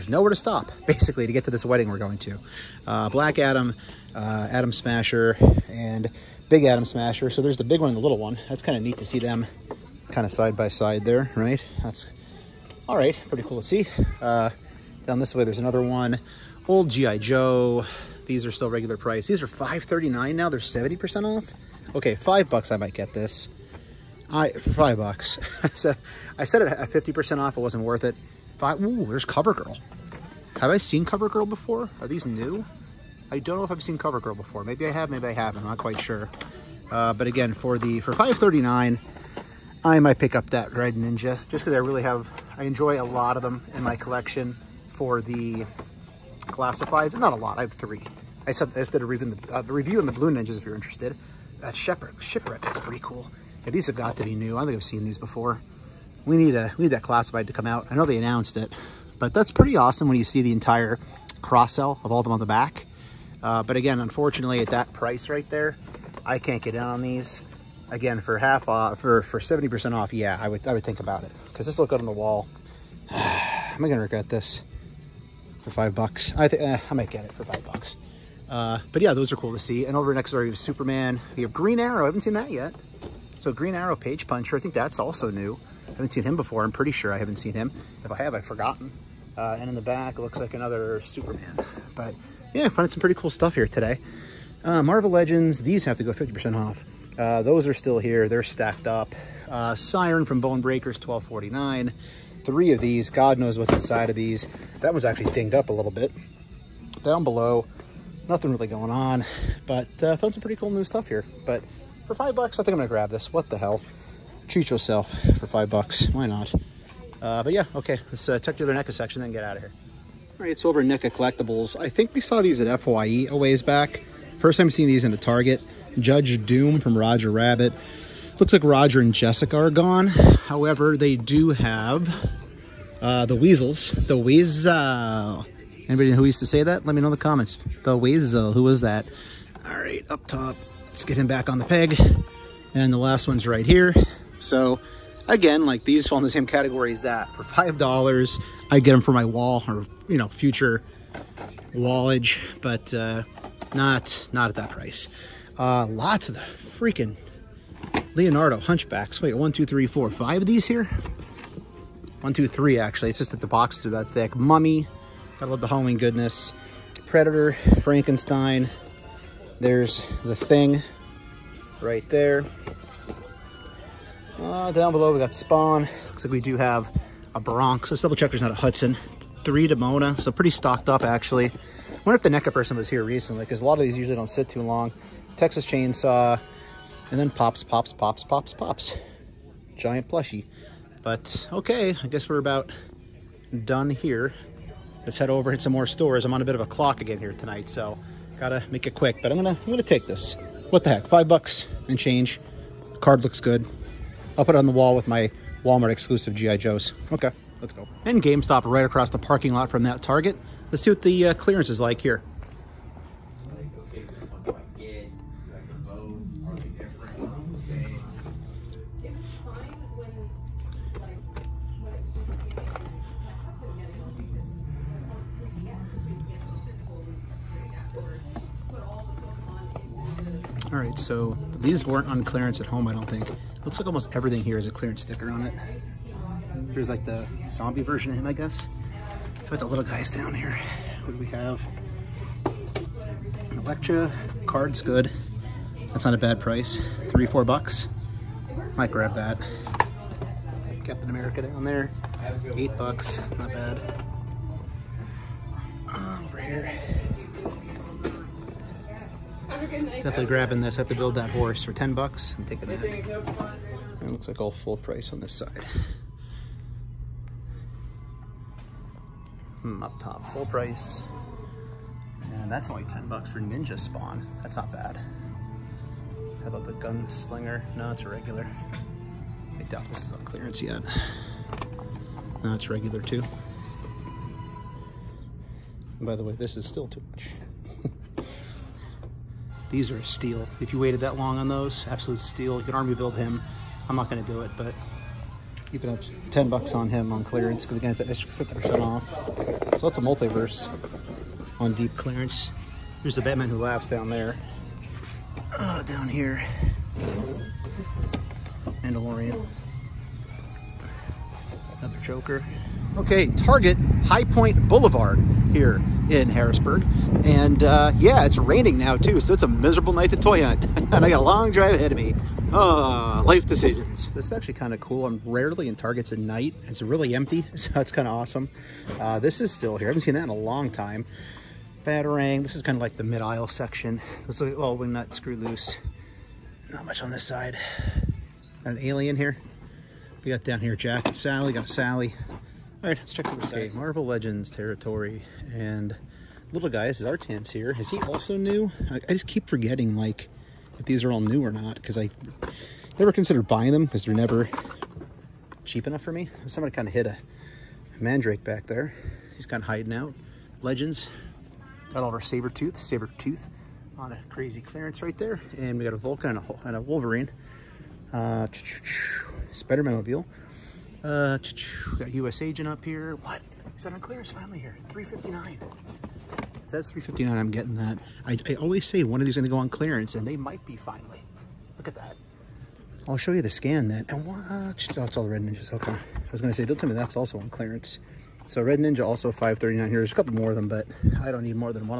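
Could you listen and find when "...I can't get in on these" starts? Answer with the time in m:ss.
1:06.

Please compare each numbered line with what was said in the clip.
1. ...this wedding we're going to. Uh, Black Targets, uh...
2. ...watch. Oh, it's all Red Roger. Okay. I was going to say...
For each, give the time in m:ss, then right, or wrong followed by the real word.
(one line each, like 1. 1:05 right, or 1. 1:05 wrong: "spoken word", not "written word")
1. 0:01 wrong: "Adam", not "Targets"
2. 6:24 wrong: "Ninjas", not "Roger".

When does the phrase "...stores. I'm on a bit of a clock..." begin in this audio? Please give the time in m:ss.
3:15.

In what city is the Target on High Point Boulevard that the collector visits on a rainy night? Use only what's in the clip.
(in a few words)
Harrisburg.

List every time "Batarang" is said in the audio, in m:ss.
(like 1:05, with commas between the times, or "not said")
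5:31.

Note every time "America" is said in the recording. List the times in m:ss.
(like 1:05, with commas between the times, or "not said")
4:11.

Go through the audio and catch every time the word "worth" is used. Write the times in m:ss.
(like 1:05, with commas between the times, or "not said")
0:27.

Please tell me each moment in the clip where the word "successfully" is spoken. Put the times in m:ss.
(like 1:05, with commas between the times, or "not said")
not said.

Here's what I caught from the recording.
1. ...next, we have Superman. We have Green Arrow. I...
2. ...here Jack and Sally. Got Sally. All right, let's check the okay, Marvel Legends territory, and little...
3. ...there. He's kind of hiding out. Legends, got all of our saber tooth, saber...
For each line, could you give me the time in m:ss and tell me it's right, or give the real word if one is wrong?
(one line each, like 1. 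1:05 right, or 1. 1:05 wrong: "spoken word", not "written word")
1. 1:20 right
2. 5:40 right
3. 5:58 right.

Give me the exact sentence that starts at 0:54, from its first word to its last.
I think I've seen these before.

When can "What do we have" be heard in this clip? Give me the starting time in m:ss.
4:01.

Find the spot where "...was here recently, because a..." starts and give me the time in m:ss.
3:02.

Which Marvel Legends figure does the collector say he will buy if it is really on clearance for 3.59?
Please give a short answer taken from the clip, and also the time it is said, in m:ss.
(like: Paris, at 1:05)
U.S. Agent, at 6:12.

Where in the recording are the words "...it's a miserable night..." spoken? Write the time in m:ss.
5:19.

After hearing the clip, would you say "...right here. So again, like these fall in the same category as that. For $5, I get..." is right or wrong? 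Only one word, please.
right.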